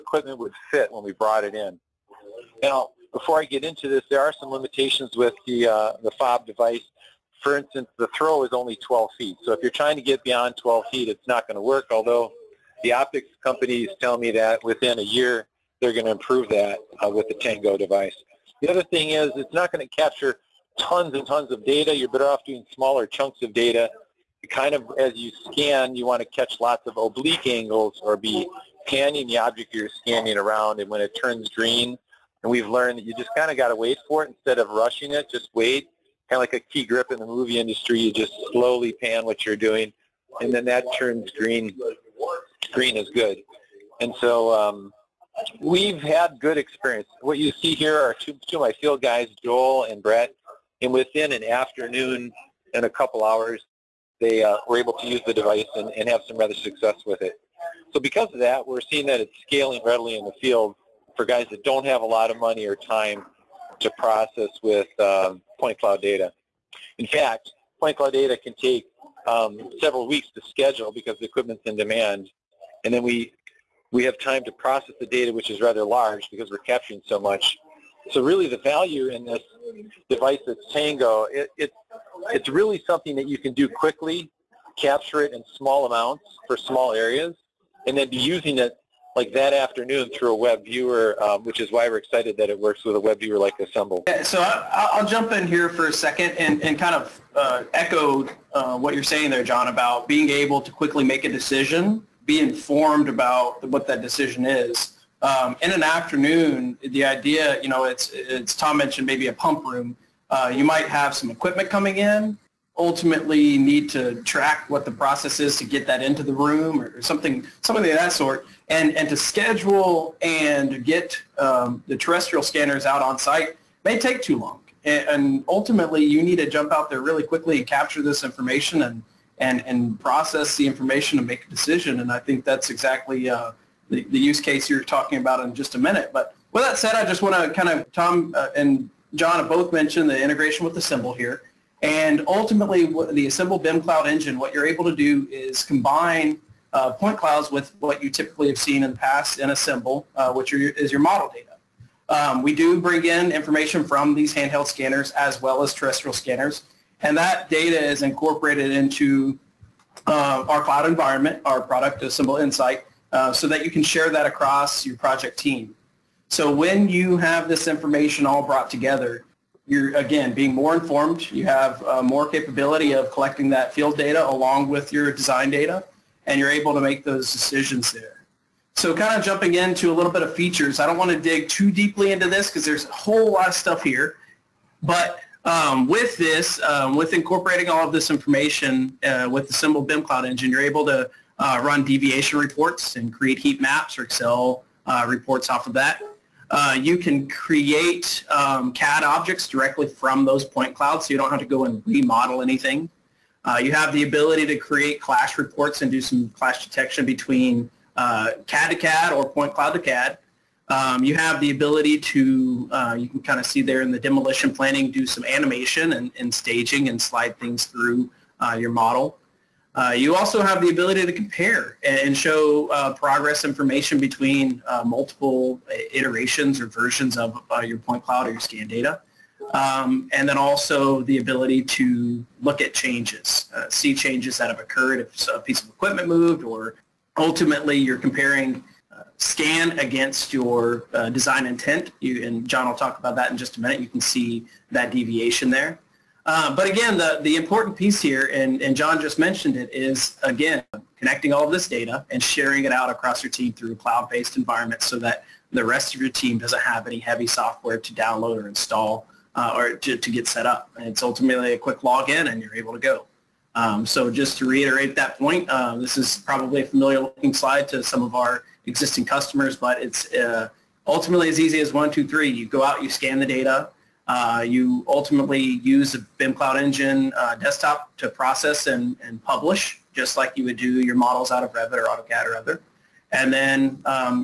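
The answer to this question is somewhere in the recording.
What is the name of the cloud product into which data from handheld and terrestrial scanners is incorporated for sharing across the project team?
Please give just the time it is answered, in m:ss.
2:42.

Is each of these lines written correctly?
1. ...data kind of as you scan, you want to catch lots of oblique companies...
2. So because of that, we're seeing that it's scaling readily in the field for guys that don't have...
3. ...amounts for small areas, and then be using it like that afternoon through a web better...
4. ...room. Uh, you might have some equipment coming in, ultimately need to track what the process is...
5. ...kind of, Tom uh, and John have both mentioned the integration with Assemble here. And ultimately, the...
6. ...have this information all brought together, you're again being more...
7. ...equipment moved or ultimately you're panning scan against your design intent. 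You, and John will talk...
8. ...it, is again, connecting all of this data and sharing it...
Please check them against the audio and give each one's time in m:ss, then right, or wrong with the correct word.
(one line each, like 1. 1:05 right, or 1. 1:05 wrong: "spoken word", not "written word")
1. 0:23 wrong: "angles", not "companies"
2. 0:57 right
3. 1:25 wrong: "viewer", not "better"
4. 1:49 right
5. 2:17 right
6. 2:47 right
7. 3:55 wrong: "comparing", not "panning"
8. 4:09 right.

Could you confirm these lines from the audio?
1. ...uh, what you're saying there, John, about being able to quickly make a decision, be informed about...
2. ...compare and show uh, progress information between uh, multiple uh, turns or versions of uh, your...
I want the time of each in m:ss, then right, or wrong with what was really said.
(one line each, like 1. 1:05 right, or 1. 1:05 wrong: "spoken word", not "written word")
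1. 1:38 right
2. 3:41 wrong: "iterations", not "turns".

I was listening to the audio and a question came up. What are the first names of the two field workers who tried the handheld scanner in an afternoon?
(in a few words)
Joel and Brett.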